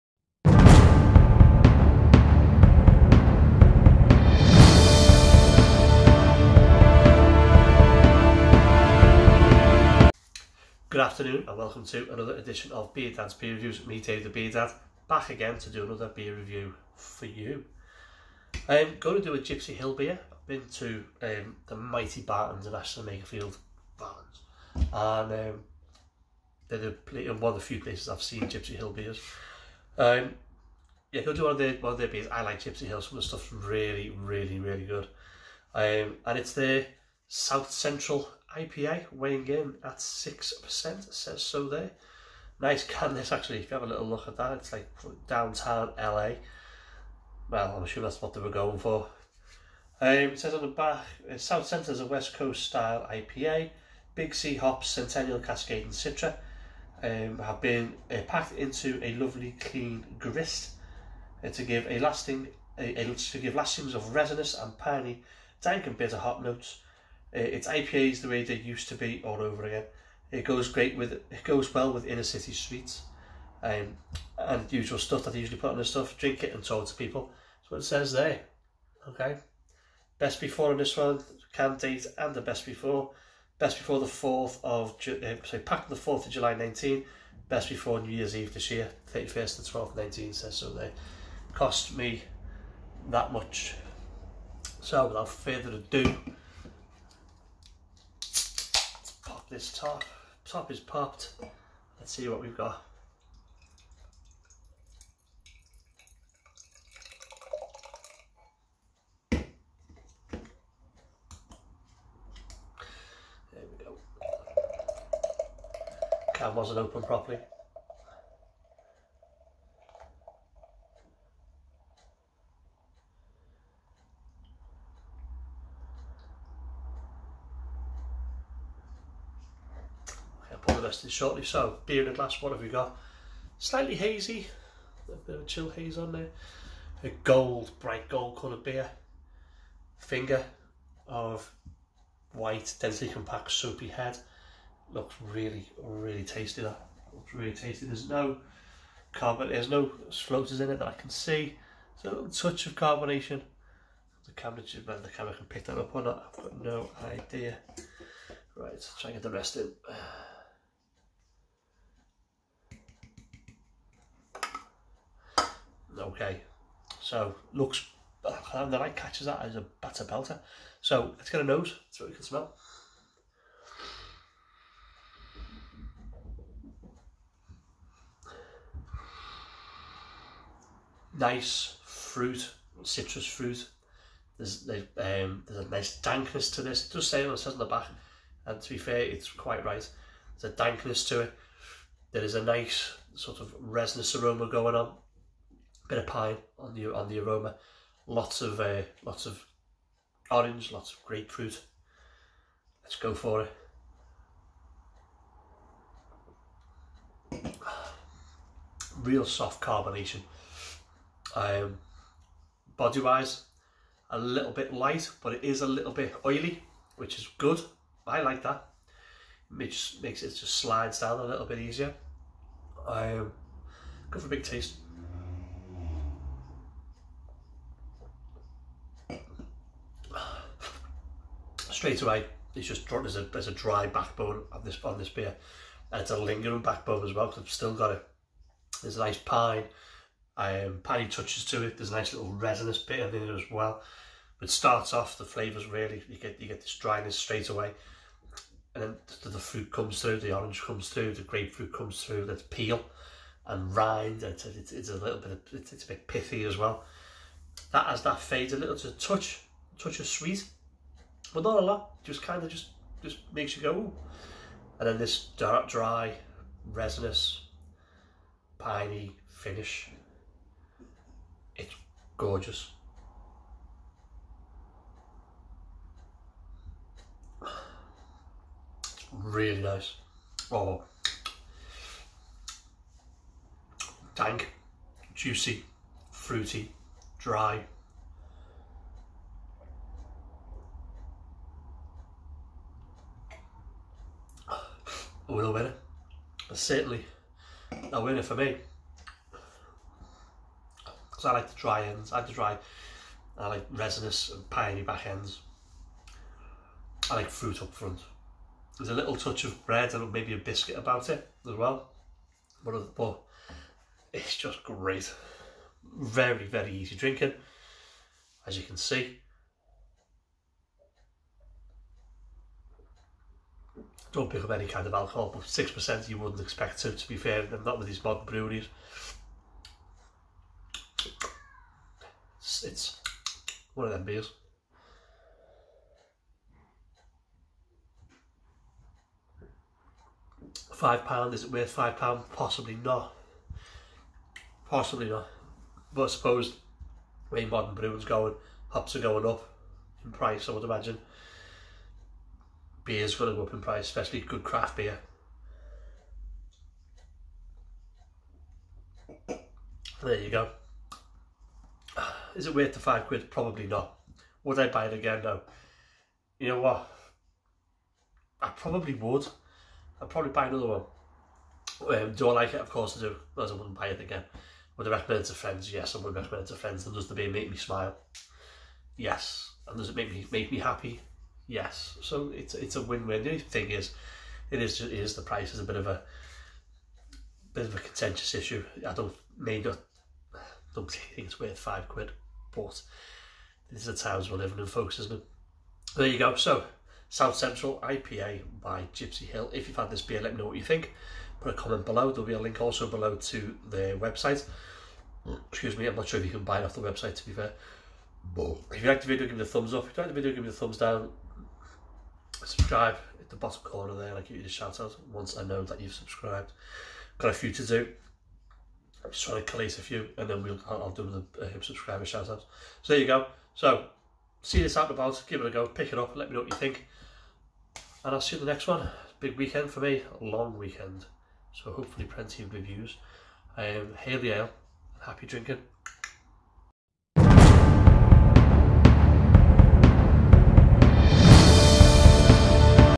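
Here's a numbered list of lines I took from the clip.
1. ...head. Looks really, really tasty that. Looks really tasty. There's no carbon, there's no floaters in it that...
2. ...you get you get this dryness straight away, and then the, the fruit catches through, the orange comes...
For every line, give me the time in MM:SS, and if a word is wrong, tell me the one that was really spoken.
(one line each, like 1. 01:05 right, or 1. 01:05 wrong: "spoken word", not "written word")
1. 02:23 right
2. 04:06 wrong: "comes", not "catches".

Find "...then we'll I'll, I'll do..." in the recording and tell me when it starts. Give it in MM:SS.
07:00.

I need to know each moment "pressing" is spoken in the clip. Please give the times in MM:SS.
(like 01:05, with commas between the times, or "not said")
not said.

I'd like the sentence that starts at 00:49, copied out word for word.
Um, it says on the back, uh, South Centre's a West Coast style IPA.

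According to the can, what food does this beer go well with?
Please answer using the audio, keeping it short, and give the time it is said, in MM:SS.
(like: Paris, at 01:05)
Inner city sweets, at 01:12.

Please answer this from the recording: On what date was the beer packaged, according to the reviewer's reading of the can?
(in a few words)
4 July 2019.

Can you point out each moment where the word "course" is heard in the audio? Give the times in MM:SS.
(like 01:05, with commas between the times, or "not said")
06:12.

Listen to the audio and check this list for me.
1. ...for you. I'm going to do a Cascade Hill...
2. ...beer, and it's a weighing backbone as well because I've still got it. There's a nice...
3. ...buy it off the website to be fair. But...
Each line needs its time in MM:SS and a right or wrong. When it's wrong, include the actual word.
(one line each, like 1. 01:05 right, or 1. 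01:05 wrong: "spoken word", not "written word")
1. 00:16 wrong: "Gipsy", not "Cascade"
2. 03:55 wrong: "lingering", not "weighing"
3. 06:46 right.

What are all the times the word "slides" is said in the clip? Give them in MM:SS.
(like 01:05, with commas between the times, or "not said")
03:40.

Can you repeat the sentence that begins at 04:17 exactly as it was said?
That as that fades a little to touch touch of sweet but not a lot.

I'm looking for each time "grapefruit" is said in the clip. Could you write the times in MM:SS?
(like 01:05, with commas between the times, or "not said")
03:21, 04:11.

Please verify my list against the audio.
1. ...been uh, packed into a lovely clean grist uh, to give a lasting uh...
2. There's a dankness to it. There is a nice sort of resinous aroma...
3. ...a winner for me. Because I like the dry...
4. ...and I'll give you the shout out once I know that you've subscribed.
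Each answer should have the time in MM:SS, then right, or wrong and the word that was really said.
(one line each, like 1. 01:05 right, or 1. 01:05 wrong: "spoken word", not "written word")
1. 00:57 right
2. 03:10 right
3. 04:57 right
4. 06:54 right.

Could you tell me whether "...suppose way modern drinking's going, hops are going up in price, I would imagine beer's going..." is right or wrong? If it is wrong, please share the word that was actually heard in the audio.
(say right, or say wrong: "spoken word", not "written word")
wrong: "brewing", not "drinking".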